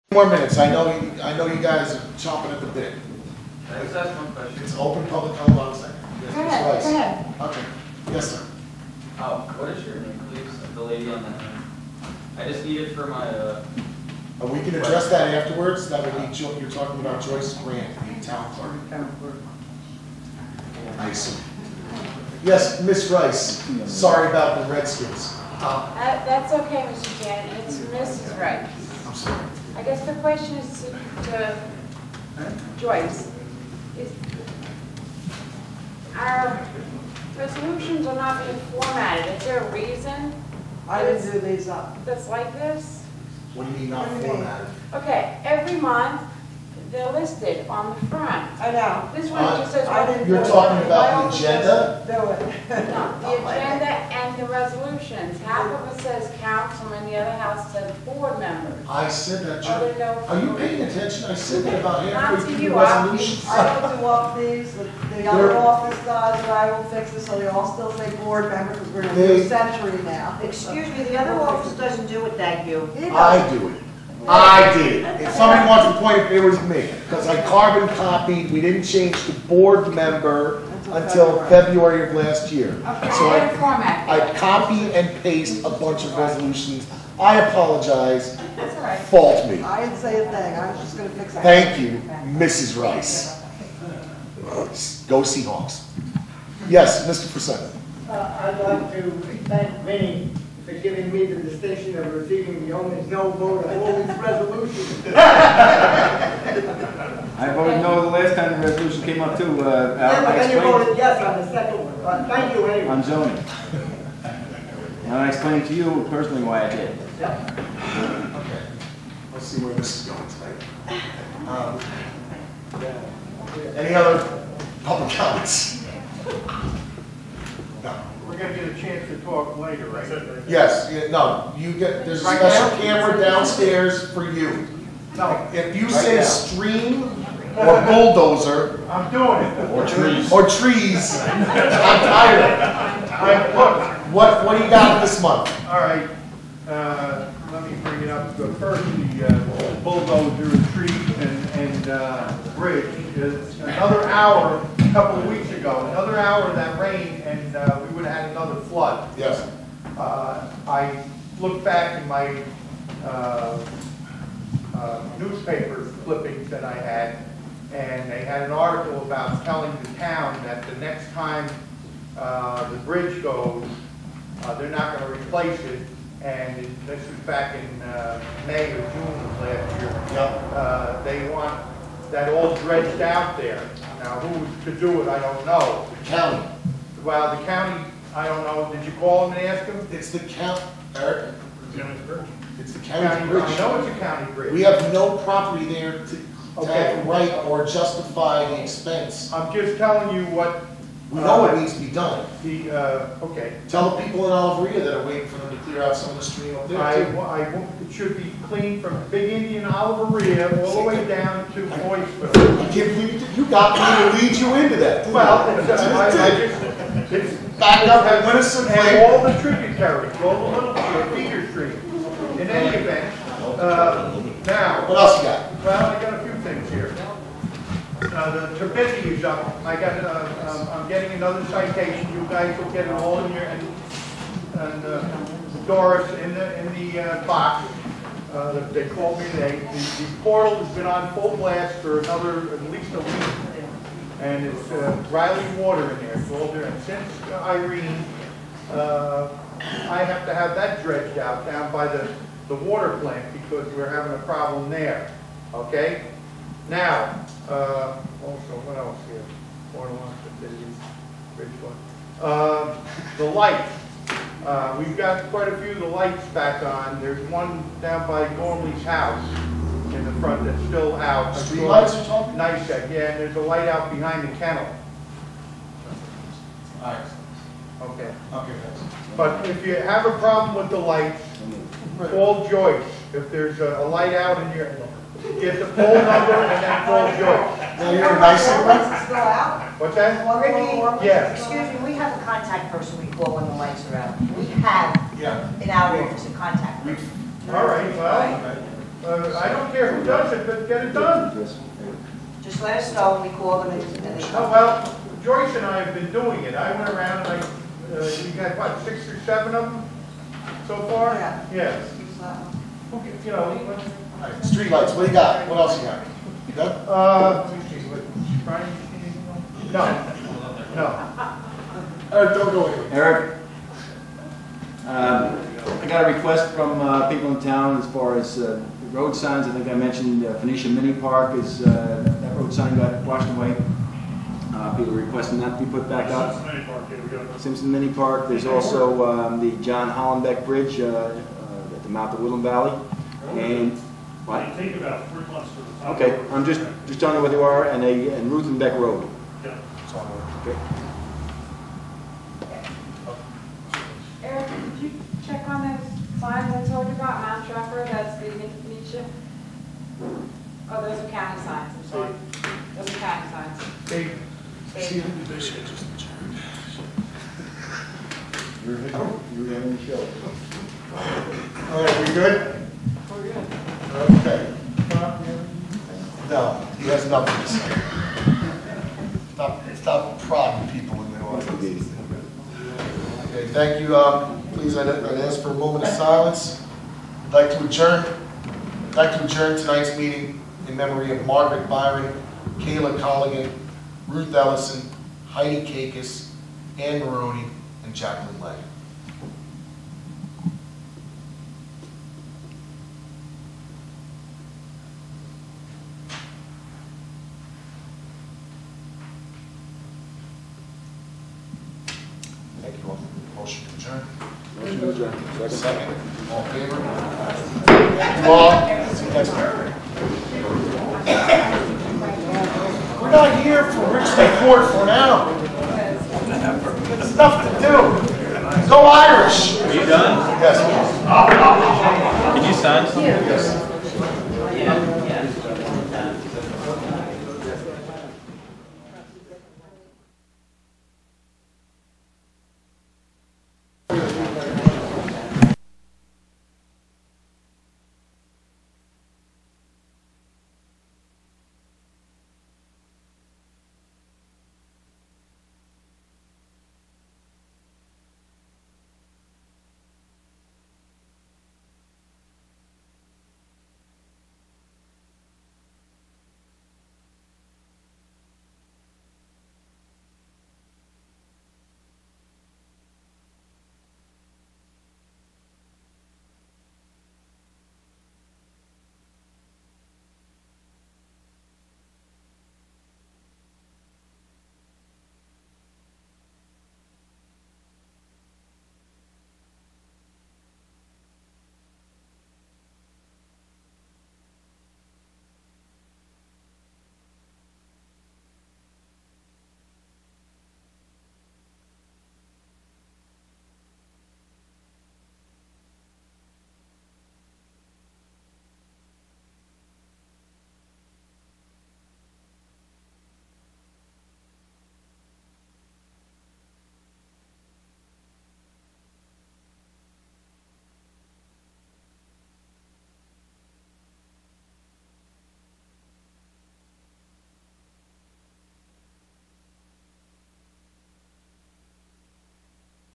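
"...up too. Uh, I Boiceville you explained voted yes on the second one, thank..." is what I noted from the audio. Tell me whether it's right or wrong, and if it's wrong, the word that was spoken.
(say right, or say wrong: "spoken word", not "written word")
wrong: "Then", not "Boiceville".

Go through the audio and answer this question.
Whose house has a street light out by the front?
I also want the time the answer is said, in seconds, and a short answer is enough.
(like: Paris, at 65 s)
Gormley's, at 268 s.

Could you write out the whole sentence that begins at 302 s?
Just let us know when we call them and they they Oh, well, Joyce and I have been doing it.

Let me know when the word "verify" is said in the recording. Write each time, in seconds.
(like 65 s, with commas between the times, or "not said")
not said.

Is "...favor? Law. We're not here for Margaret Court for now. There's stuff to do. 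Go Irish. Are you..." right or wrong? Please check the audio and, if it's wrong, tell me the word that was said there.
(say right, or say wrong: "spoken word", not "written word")
wrong: "Richmond", not "Margaret".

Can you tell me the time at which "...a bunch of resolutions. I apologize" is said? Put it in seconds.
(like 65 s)
85 s.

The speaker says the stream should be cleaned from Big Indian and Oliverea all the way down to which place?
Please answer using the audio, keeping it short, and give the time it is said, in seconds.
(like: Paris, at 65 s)
Boiceville, at 211 s.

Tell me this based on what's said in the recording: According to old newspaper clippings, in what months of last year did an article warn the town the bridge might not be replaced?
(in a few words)
May or June.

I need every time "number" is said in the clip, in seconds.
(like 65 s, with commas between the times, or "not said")
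285 s.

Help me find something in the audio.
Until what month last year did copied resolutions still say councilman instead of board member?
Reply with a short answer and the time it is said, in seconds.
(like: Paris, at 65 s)
February, at 81 s.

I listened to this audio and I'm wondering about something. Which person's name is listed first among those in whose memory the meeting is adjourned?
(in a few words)
Margaret Byron.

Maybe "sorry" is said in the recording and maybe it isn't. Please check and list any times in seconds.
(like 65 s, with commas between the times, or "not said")
23 s, 29 s, 361 s.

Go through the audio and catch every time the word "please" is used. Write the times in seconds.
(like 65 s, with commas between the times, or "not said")
10 s, 384 s.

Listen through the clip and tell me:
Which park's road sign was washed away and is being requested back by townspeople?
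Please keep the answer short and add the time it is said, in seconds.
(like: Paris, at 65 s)
Phoenicia Mini Park, at 330 s.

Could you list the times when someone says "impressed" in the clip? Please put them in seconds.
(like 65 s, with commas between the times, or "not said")
not said.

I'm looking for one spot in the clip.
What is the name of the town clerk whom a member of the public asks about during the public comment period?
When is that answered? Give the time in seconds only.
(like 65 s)
17 s.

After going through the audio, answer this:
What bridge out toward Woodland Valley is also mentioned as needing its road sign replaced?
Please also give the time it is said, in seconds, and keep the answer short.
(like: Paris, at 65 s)
John Hollenbeck Bridge, at 339 s.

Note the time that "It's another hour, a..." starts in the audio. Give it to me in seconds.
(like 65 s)
153 s.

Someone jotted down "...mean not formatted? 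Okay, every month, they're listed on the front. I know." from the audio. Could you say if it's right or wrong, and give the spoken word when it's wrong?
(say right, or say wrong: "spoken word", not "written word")
right.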